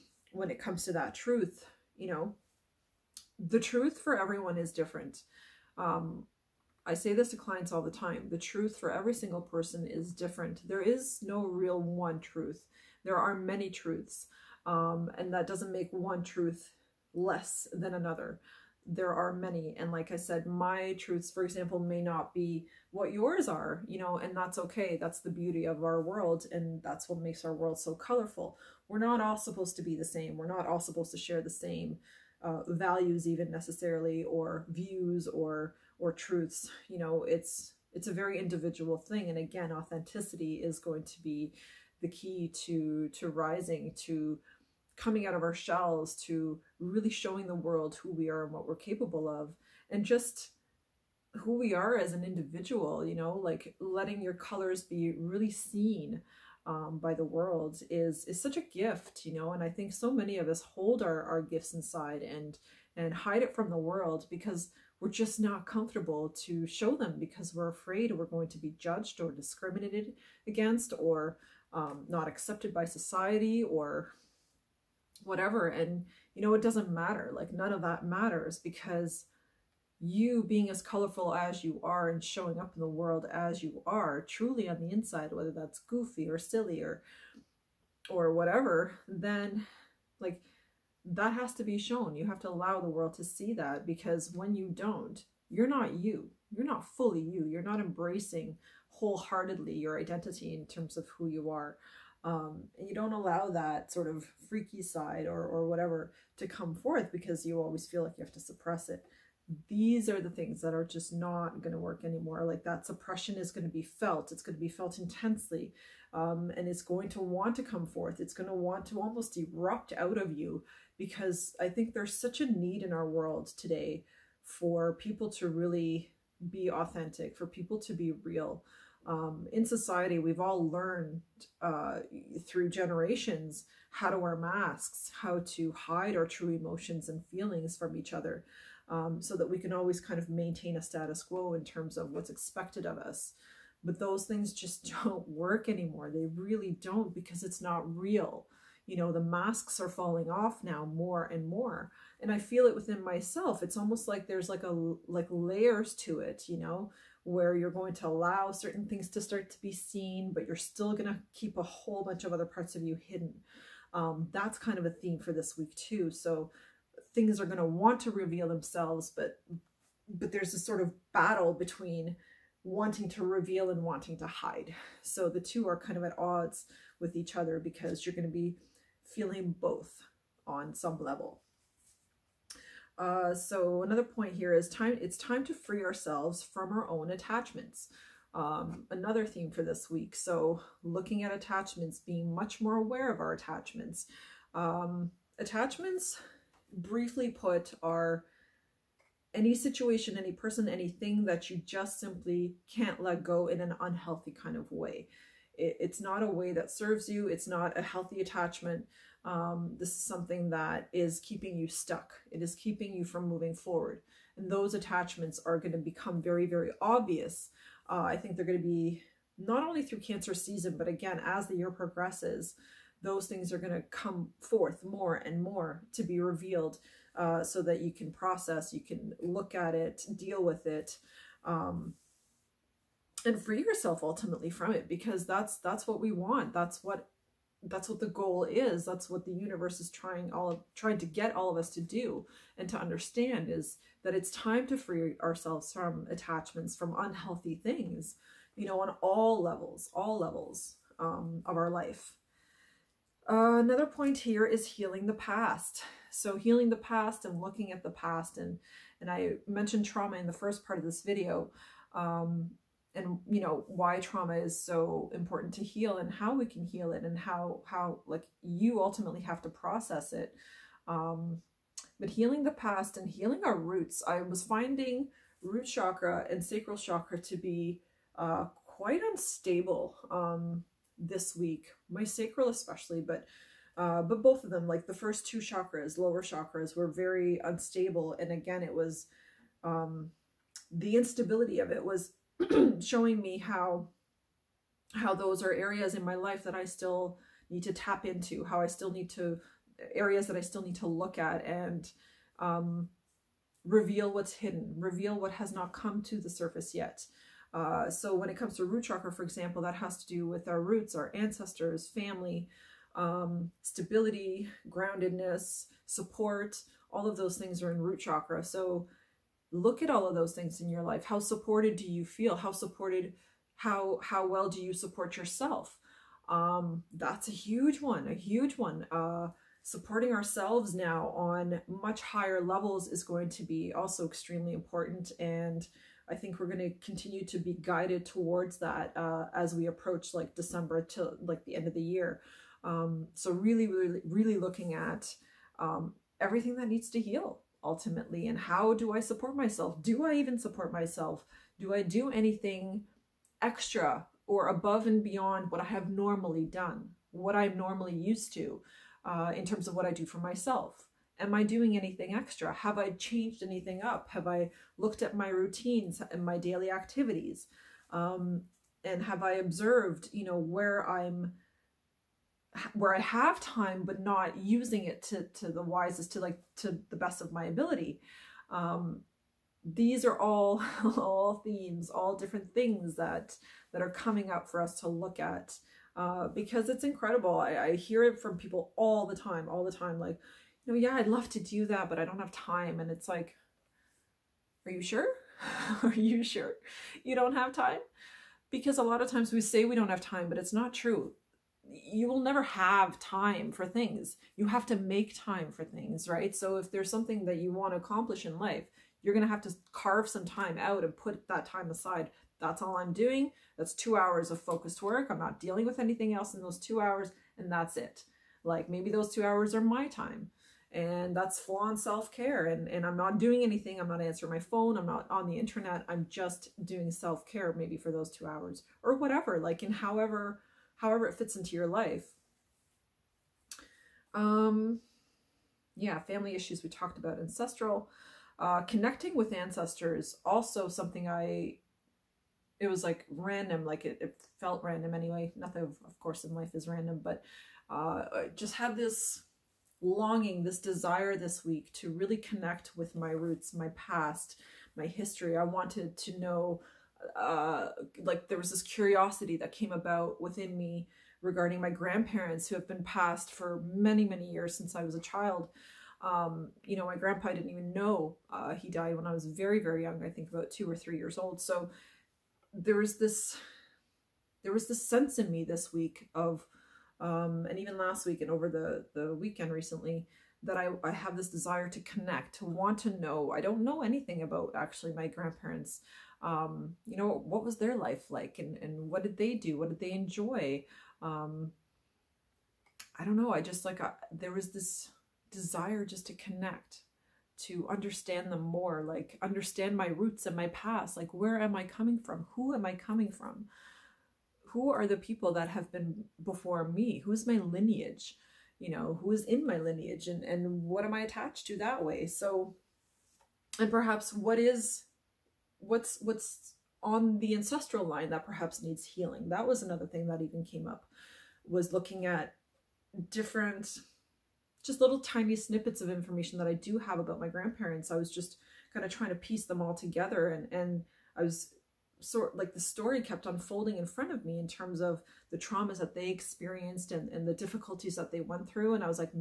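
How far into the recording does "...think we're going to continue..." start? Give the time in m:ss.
5:36.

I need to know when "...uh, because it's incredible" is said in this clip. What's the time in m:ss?
6:25.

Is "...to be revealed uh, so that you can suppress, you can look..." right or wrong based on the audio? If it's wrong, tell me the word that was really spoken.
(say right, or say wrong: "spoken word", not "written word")
wrong: "process", not "suppress".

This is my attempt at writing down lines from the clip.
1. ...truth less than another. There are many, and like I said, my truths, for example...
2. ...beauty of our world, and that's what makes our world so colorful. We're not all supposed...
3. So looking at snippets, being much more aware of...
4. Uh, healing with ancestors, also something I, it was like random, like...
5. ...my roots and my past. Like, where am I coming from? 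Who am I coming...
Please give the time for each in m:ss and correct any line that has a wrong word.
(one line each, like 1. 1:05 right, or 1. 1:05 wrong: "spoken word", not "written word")
1. 0:16 right
2. 0:25 right
3. 3:10 wrong: "attachments", not "snippets"
4. 7:18 wrong: "connecting", not "healing"
5. 8:19 right.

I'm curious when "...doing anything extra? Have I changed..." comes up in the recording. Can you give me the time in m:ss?
6:01.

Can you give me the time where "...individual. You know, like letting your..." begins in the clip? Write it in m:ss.
0:52.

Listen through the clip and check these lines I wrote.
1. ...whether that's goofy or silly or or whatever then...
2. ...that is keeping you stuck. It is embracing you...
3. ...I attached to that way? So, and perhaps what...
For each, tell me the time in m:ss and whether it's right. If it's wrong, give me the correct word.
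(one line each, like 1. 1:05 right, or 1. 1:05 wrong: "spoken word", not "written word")
1. 1:25 right
2. 3:30 wrong: "keeping", not "embracing"
3. 8:30 right.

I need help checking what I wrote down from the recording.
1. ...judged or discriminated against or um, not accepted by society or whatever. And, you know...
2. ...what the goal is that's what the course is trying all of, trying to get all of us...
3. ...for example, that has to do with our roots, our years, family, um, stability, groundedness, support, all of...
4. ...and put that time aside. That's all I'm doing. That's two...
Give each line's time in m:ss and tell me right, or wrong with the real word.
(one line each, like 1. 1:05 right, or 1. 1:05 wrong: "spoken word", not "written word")
1. 1:08 right
2. 3:57 wrong: "universe", not "course"
3. 5:09 wrong: "ancestors", not "years"
4. 6:50 right.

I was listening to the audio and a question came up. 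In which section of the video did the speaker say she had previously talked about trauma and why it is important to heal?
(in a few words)
The first part.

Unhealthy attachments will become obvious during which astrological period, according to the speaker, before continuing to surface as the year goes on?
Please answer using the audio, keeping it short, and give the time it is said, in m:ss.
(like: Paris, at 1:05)
Cancer season, at 3:39.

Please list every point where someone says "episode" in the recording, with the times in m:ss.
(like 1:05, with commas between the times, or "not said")
not said.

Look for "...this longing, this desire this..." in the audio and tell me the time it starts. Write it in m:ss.
7:28.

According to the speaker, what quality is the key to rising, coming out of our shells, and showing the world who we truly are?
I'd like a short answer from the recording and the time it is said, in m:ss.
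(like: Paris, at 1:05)
Authenticity, at 0:39.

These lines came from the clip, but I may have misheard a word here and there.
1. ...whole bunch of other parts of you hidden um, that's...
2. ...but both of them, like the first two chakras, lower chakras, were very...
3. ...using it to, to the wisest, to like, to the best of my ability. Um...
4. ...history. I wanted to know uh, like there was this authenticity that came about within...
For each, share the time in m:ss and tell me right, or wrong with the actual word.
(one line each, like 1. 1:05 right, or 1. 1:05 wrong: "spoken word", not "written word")
1. 2:41 right
2. 4:44 right
3. 6:14 right
4. 7:34 wrong: "curiosity", not "authenticity".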